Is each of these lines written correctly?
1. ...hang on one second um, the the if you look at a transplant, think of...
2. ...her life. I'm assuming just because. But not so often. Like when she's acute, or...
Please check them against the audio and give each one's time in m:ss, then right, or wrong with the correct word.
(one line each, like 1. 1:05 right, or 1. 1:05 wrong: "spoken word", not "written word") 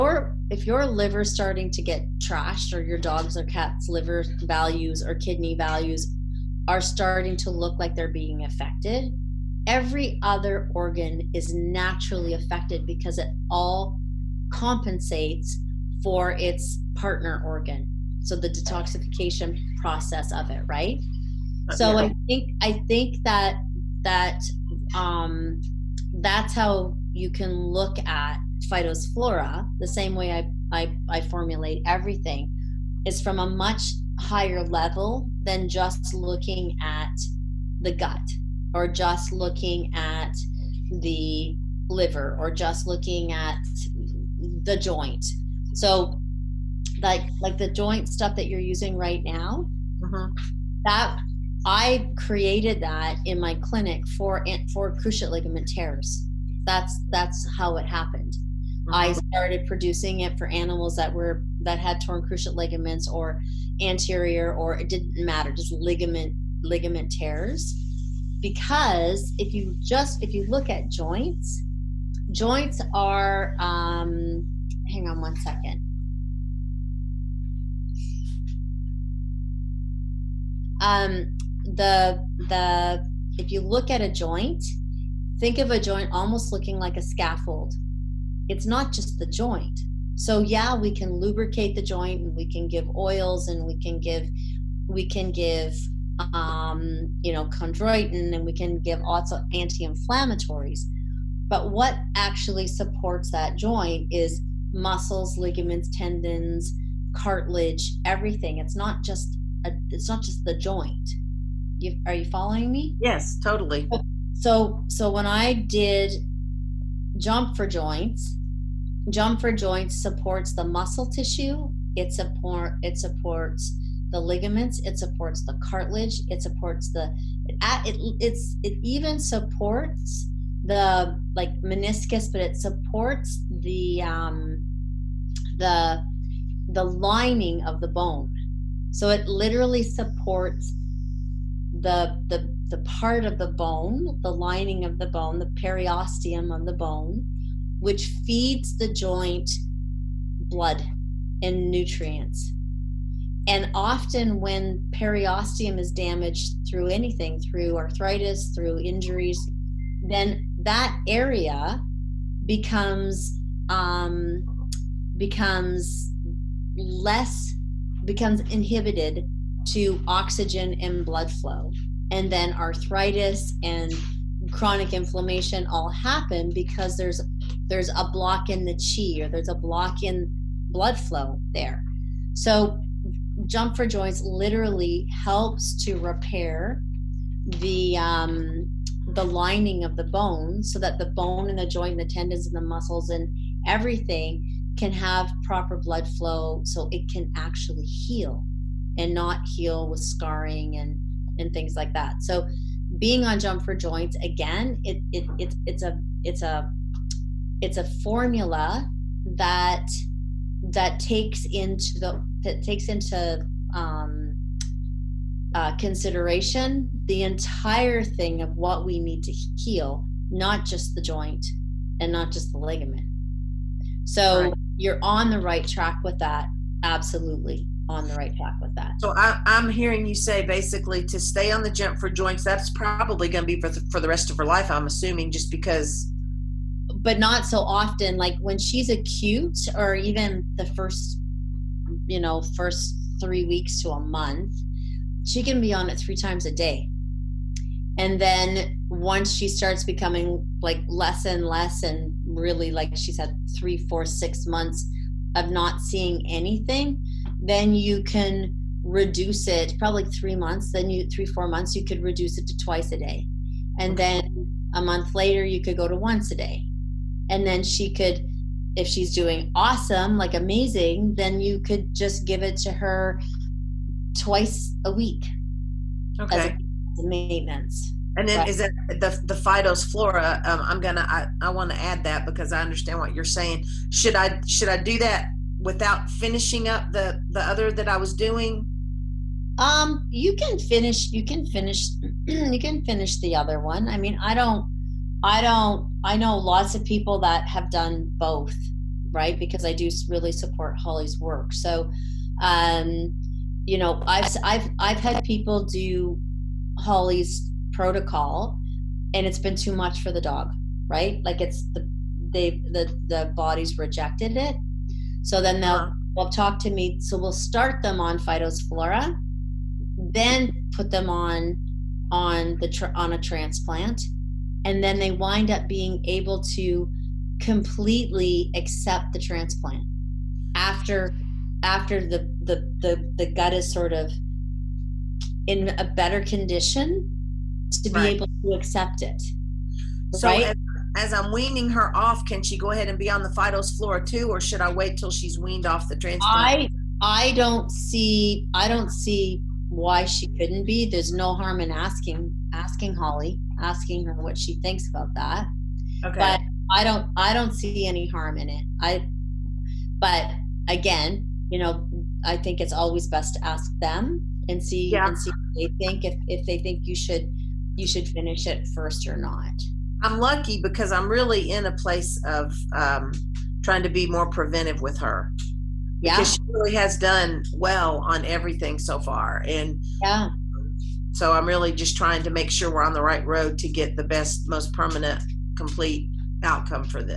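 1. 1:14 wrong: "joint", not "transplant"
2. 3:54 right.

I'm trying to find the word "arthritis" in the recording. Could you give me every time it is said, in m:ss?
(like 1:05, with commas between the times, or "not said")
2:37, 2:52.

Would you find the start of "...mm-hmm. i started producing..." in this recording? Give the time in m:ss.
0:58.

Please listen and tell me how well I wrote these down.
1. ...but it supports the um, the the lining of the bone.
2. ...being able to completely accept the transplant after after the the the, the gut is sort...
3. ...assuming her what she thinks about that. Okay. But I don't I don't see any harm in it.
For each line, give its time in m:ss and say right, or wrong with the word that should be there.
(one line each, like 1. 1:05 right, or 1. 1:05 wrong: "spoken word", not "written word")
1. 2:12 right
2. 5:25 right
3. 5:53 wrong: "asking", not "assuming".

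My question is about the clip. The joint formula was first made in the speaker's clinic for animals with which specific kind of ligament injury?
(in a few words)
cruciate ligament tears.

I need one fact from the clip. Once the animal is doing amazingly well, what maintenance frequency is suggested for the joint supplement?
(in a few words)
twice a week.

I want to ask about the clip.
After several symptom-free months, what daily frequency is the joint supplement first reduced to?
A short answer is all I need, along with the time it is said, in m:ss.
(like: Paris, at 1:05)
twice a day, at 4:22.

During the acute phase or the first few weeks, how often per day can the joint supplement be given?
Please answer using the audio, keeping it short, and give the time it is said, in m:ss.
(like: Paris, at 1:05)
3 times a day, at 4:05.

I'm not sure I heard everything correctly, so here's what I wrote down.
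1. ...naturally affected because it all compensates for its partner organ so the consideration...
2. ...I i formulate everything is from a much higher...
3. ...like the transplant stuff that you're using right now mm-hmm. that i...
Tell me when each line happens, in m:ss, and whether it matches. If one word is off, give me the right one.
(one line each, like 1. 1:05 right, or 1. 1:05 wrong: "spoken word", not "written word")
1. 0:11 wrong: "detoxification", not "consideration"
2. 0:30 right
3. 0:47 wrong: "joint", not "transplant".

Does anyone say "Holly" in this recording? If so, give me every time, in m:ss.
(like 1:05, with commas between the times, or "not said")
5:00, 5:06, 5:52.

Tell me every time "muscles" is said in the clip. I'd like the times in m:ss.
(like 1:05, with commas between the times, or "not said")
1:44, 2:00, 3:12.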